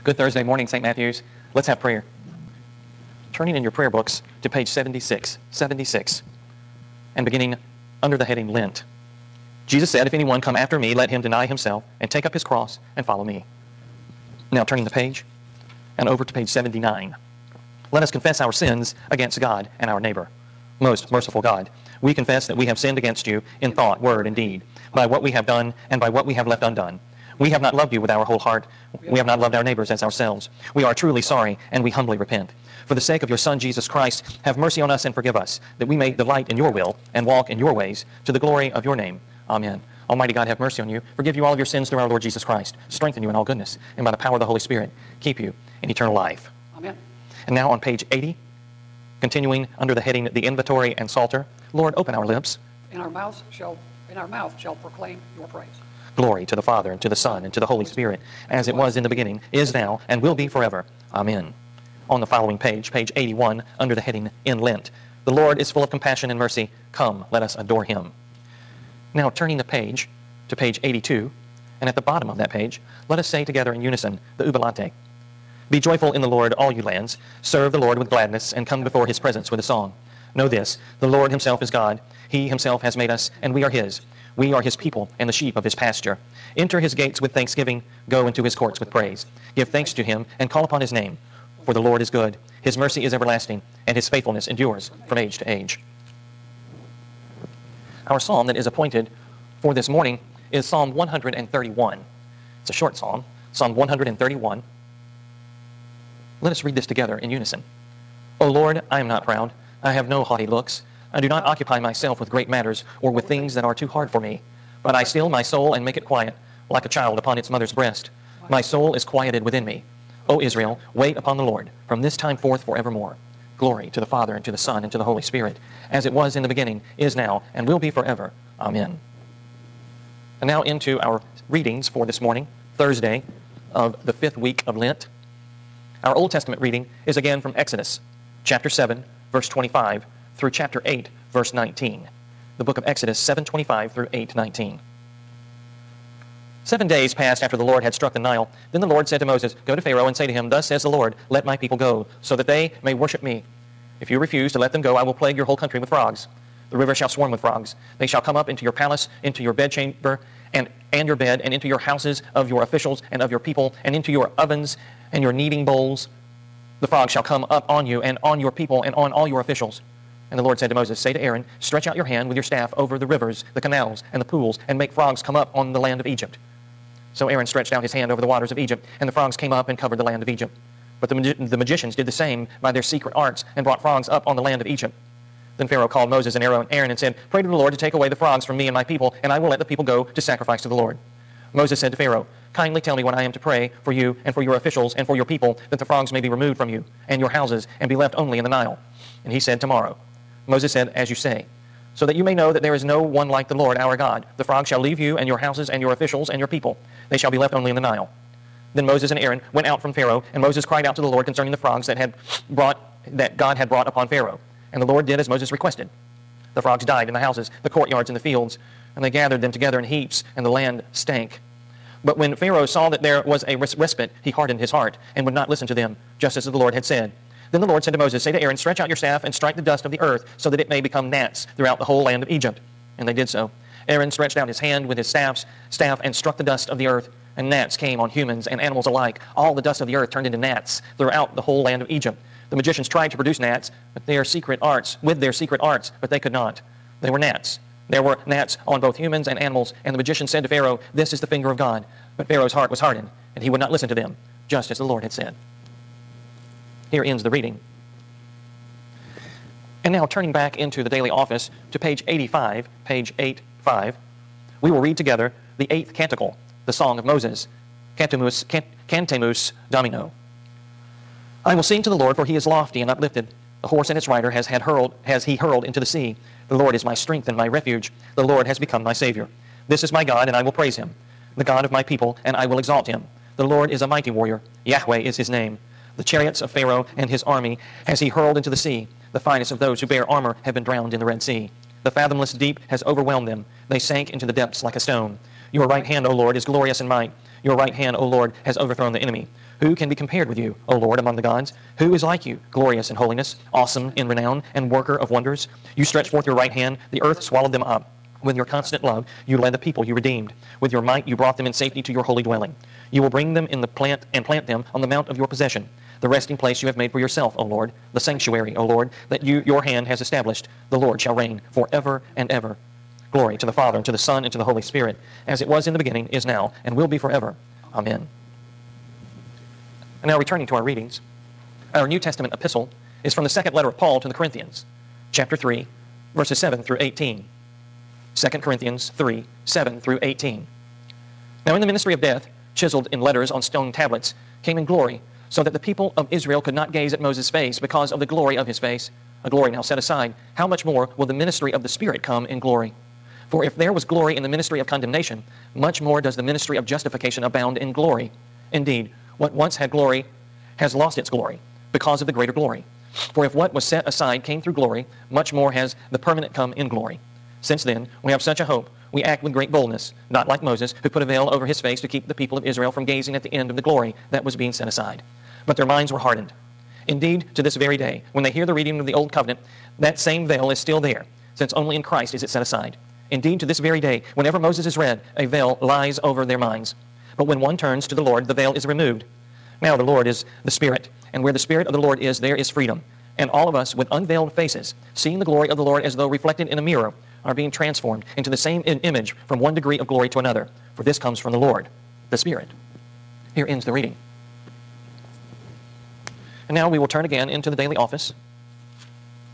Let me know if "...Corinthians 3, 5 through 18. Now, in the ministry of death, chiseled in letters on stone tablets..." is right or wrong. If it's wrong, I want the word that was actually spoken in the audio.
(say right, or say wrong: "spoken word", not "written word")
wrong: "7", not "5".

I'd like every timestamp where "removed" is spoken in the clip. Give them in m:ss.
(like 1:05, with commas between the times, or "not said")
3:16, 6:28.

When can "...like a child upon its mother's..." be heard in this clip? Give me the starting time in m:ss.
1:56.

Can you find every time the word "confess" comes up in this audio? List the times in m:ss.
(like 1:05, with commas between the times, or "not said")
0:18, 0:22.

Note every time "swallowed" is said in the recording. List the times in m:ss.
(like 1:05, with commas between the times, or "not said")
5:07.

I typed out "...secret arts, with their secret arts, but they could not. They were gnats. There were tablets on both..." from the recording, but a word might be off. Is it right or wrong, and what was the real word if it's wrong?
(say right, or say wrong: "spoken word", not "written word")
wrong: "gnats", not "tablets".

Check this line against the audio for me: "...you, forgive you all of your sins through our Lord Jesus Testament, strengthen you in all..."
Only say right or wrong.
wrong.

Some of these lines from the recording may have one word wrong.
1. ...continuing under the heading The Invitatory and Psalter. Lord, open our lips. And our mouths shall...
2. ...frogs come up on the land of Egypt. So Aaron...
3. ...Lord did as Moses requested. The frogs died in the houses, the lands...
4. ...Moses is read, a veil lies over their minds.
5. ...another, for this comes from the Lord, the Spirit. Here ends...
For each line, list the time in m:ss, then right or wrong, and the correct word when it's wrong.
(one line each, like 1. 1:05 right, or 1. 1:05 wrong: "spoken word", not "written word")
1. 0:49 right
2. 2:54 right
3. 3:34 wrong: "courtyards", not "lands"
4. 6:24 right
5. 6:40 right.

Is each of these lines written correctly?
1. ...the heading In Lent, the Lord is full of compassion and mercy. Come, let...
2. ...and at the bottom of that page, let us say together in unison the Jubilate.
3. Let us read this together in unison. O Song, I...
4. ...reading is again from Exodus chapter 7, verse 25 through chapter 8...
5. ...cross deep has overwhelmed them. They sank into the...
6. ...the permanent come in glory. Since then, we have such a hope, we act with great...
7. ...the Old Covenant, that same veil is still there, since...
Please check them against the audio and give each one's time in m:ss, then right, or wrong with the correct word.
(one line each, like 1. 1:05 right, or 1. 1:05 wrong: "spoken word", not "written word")
1. 1:03 right
2. 1:11 right
3. 1:46 wrong: "Lord", not "Song"
4. 2:16 right
5. 4:51 wrong: "fathomless", not "cross"
6. 6:05 right
7. 6:18 right.